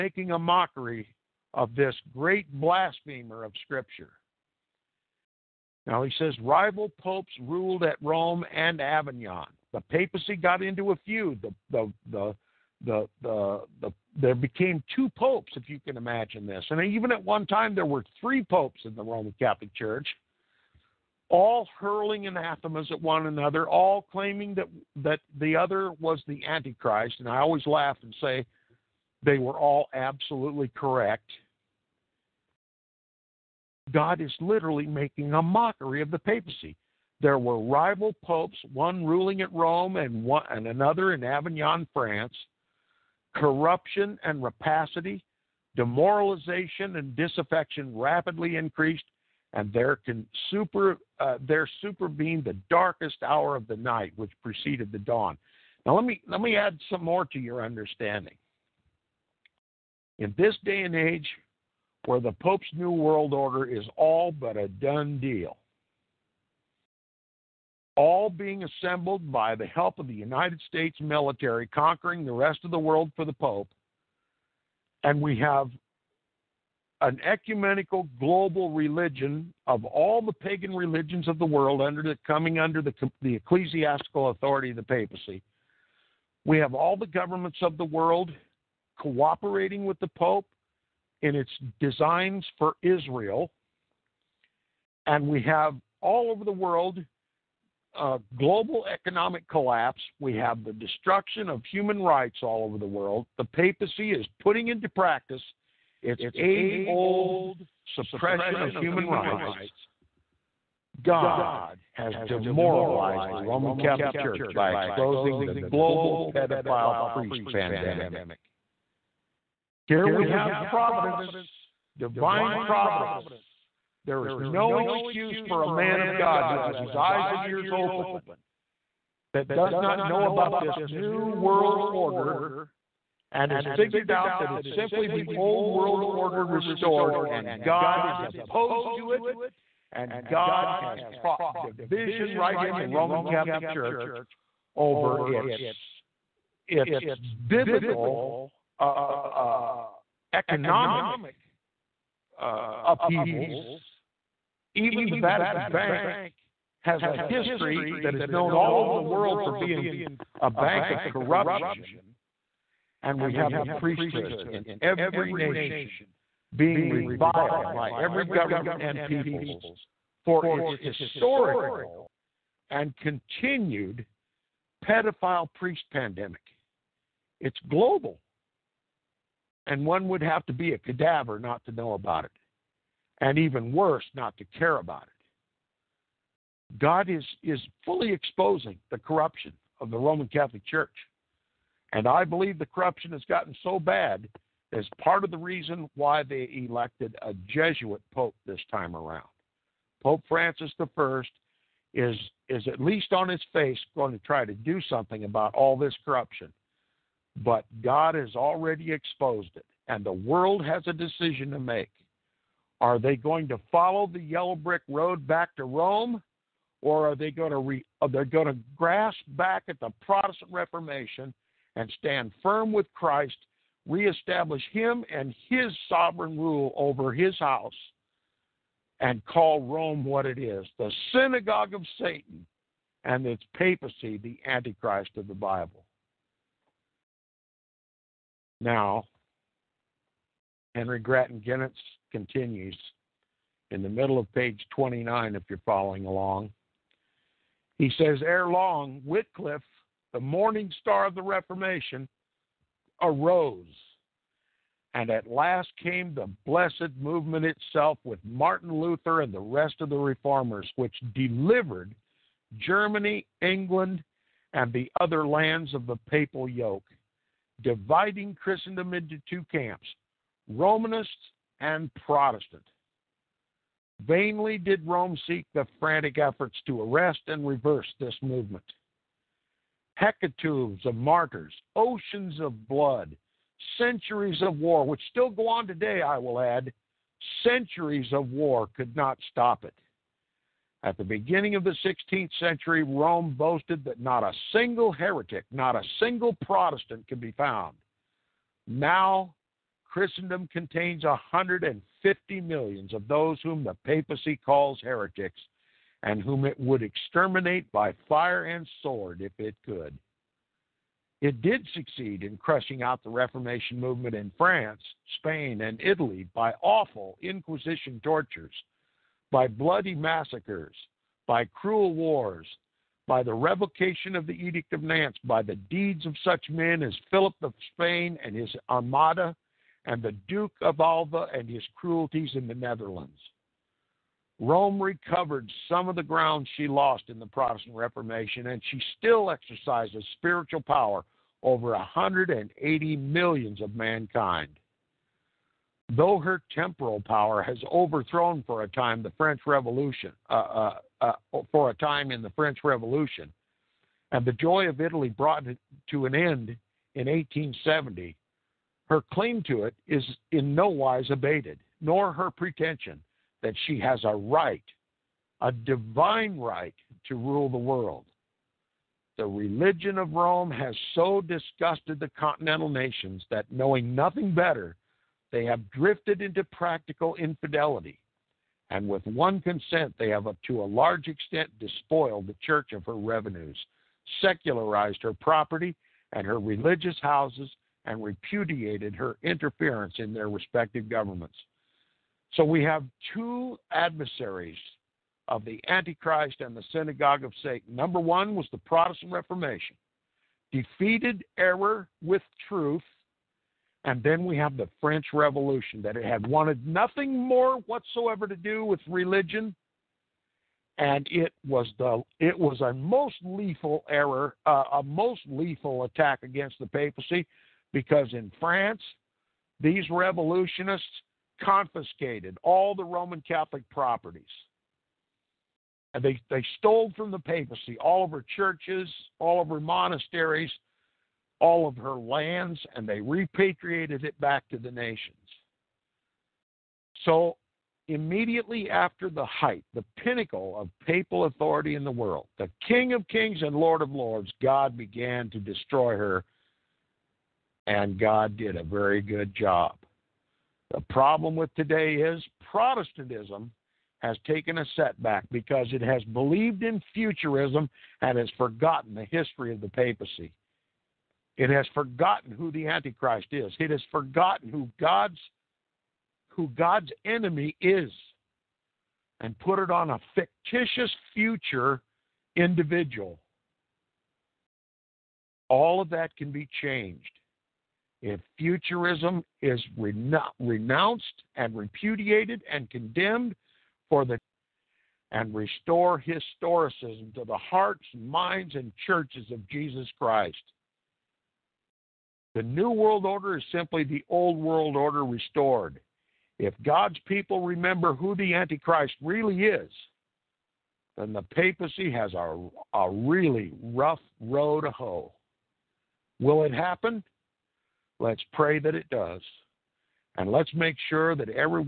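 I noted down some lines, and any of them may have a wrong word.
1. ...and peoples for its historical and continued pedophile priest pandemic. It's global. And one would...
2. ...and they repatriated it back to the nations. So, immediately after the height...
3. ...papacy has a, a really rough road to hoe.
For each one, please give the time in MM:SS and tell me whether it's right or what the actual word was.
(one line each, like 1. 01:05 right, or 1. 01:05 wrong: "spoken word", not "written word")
1. 02:48 right
2. 07:12 right
3. 08:21 right.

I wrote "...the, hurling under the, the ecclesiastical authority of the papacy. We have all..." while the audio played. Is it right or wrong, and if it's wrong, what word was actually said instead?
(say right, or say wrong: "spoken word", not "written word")
wrong: "coming", not "hurling".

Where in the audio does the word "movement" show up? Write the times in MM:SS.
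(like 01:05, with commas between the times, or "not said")
04:16, 04:38, 05:13.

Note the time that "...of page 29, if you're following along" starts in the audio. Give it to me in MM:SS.
04:04.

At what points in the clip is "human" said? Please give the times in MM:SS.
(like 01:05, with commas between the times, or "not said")
01:41, 01:48.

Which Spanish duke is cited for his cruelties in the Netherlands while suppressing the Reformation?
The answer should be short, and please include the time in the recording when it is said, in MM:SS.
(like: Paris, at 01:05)
Duke of Alva, at 05:30.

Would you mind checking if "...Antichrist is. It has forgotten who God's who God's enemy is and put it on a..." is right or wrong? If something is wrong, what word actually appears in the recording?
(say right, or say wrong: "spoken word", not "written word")
right.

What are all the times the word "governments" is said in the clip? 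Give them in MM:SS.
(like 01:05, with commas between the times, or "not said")
01:27, 02:48, 06:30.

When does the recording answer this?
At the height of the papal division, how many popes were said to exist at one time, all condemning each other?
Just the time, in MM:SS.
00:18.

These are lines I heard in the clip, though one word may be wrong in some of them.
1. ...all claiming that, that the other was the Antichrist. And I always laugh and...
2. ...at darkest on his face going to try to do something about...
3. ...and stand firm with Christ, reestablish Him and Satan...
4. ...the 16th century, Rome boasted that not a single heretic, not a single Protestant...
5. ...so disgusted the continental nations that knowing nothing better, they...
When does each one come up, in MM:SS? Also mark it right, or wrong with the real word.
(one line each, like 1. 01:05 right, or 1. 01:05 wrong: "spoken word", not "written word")
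1. 00:23 right
2. 03:22 wrong: "least", not "darkest"
3. 03:41 wrong: "His", not "Satan"
4. 04:51 right
5. 06:10 right.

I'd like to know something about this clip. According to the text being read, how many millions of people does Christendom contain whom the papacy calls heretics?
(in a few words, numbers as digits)
150 million.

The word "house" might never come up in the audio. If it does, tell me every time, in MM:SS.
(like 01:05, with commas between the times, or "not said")
03:47, 06:27.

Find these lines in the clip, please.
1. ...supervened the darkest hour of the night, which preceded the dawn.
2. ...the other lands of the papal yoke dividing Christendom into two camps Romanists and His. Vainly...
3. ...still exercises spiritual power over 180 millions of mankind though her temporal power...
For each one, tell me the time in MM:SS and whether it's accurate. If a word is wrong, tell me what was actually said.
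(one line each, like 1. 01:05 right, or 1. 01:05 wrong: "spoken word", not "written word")
1. 00:51 right
2. 04:24 wrong: "Protestant", not "His"
3. 05:38 right.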